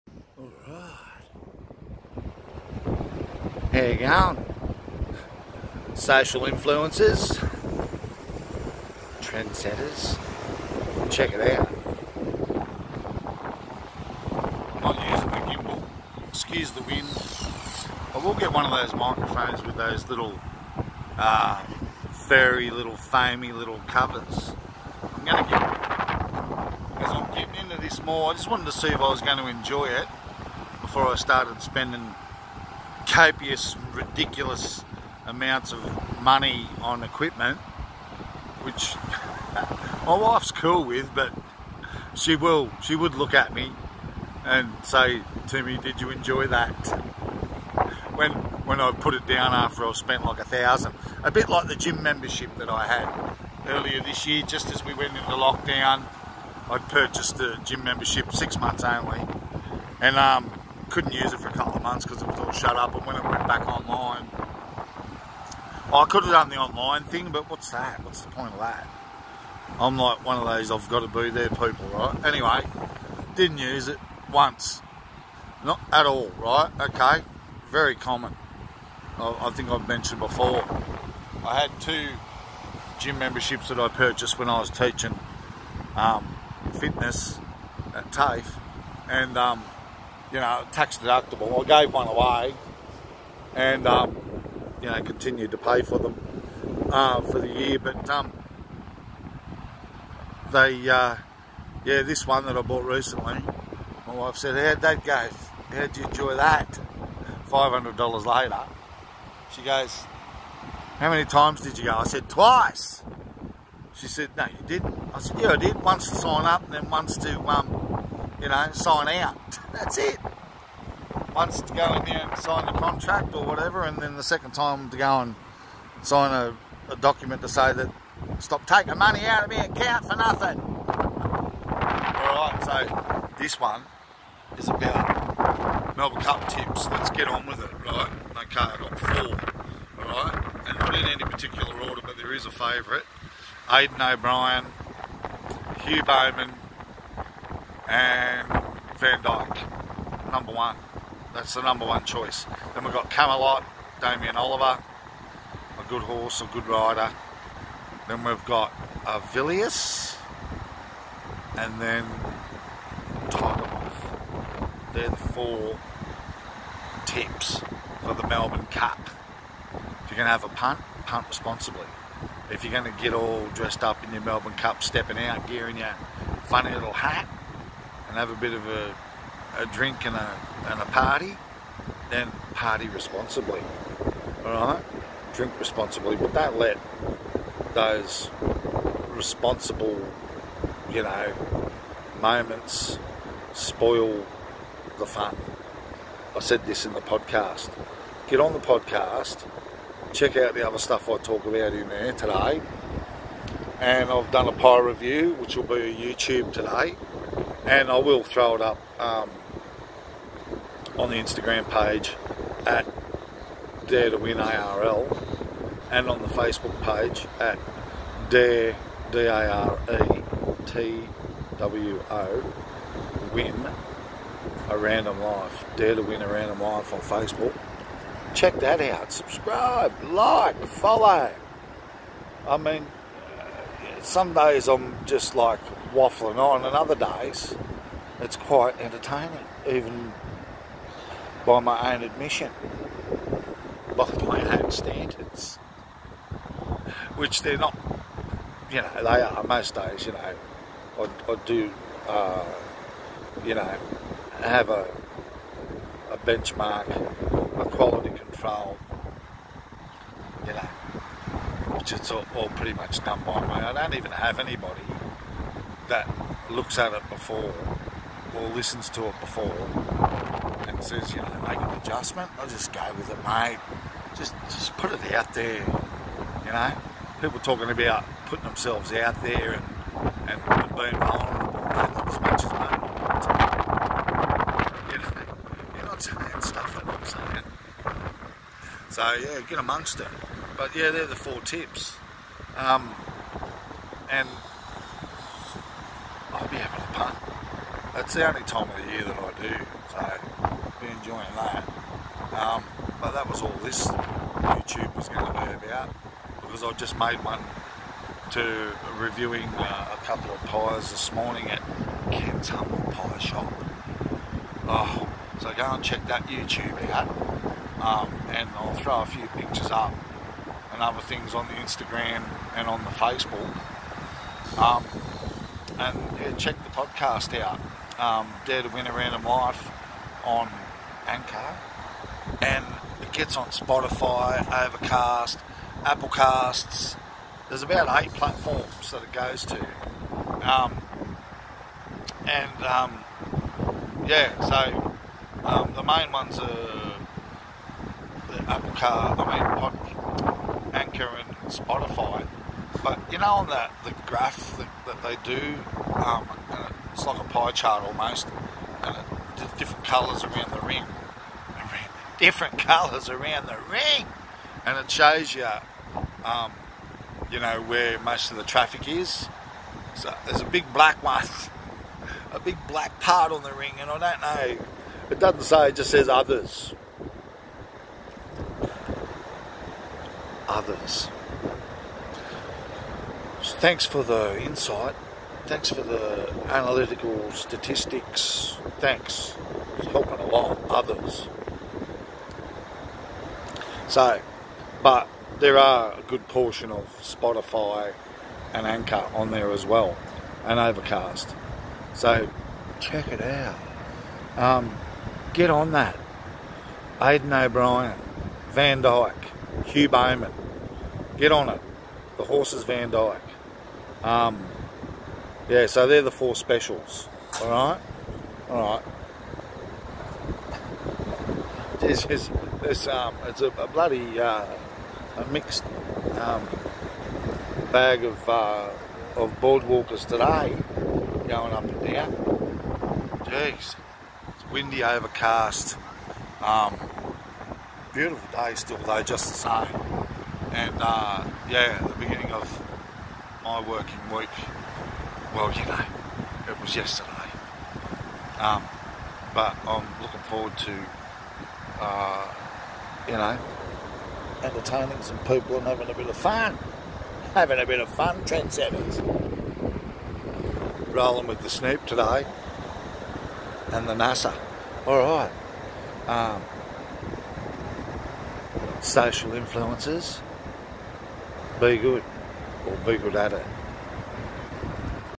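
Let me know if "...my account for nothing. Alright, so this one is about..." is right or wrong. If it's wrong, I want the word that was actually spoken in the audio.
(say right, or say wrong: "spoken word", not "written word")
right.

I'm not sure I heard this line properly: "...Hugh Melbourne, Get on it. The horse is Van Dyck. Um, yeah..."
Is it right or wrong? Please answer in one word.
wrong.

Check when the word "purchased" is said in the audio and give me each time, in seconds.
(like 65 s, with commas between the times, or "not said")
56 s, 83 s.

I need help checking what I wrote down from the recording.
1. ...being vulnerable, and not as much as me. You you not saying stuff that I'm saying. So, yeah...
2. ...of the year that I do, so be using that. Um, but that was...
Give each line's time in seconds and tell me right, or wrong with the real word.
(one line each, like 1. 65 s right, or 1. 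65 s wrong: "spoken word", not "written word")
1. 280 s right
2. 298 s wrong: "enjoying", not "using".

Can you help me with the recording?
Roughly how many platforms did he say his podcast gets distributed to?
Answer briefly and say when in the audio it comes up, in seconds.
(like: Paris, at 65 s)
8, at 338 s.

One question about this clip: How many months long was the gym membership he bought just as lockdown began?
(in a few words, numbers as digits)
6.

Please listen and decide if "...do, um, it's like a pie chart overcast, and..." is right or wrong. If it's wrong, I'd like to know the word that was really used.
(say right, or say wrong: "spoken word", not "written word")
wrong: "almost", not "overcast".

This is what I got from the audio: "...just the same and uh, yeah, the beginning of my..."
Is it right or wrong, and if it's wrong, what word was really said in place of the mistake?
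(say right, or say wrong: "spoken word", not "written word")
right.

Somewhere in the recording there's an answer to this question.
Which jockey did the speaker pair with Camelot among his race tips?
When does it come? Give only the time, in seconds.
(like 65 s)
153 s.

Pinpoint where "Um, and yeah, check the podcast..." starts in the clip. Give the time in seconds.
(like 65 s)
324 s.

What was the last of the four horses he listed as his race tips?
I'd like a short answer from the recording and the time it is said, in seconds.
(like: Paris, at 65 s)
Tiger Moth, at 163 s.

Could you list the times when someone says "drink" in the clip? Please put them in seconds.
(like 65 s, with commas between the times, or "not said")
179 s, 185 s.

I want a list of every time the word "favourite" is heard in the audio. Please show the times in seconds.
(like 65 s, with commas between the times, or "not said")
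142 s.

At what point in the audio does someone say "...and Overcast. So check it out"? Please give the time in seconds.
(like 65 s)
400 s.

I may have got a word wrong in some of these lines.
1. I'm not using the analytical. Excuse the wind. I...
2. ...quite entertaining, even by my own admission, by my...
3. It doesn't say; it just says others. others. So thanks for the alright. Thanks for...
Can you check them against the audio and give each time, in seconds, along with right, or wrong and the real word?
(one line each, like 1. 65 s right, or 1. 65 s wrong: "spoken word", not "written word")
1. 14 s wrong: "gimbal", not "analytical"
2. 238 s right
3. 375 s wrong: "insight", not "alright".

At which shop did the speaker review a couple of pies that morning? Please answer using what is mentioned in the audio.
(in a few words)
Ken's Humble Pie Shop.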